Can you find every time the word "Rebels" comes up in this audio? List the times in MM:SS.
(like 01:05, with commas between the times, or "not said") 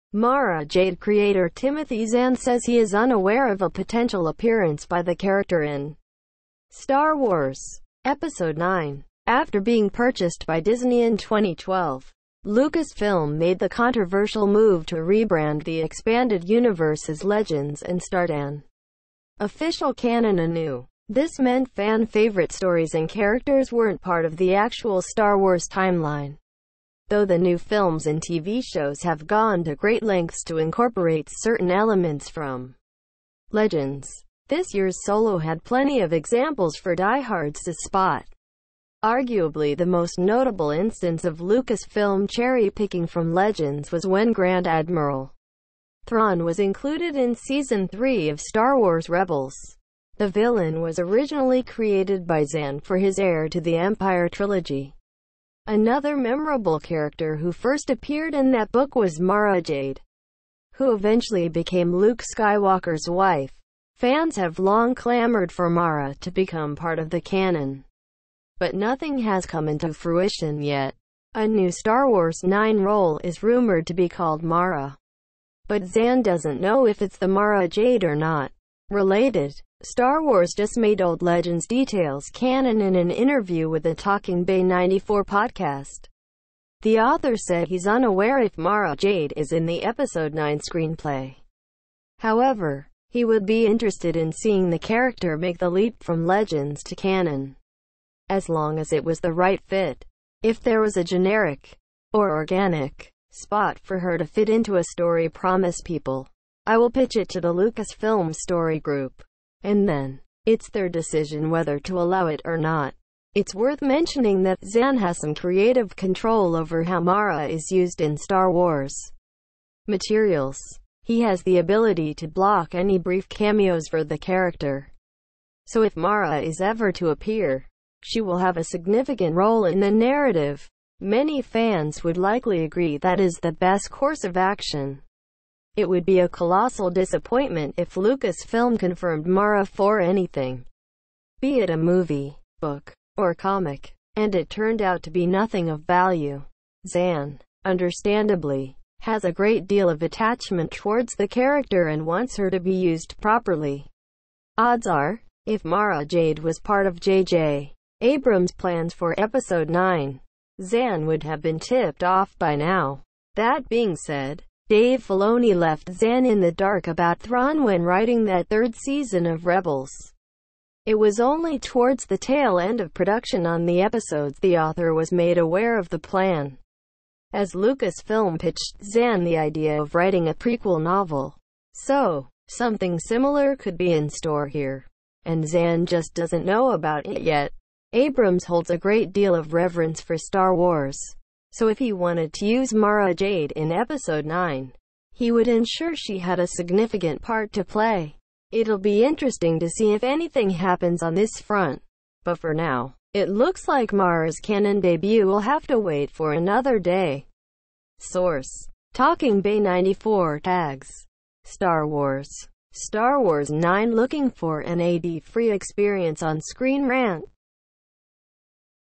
00:49, 02:49.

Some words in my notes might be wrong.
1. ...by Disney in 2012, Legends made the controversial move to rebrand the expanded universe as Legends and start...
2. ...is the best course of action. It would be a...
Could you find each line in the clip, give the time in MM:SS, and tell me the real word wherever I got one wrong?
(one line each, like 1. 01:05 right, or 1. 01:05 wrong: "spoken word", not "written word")
1. 00:10 wrong: "Lucasfilm", not "Legends"
2. 02:13 right.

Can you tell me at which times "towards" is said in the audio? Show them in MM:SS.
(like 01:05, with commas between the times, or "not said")
02:30, 02:51.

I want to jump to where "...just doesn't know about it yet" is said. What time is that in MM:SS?
03:05.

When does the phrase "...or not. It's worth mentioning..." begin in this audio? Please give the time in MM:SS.
01:52.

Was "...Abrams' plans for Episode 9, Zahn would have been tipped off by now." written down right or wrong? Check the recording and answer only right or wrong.
right.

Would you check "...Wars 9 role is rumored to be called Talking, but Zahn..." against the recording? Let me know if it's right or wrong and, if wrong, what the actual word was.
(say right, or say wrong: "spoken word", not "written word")
wrong: "Mara", not "Talking".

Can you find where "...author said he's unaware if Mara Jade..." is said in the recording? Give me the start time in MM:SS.
01:26.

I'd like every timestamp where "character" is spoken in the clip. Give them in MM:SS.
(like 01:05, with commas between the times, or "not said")
00:05, 00:23, 00:56, 01:34, 02:04, 02:31.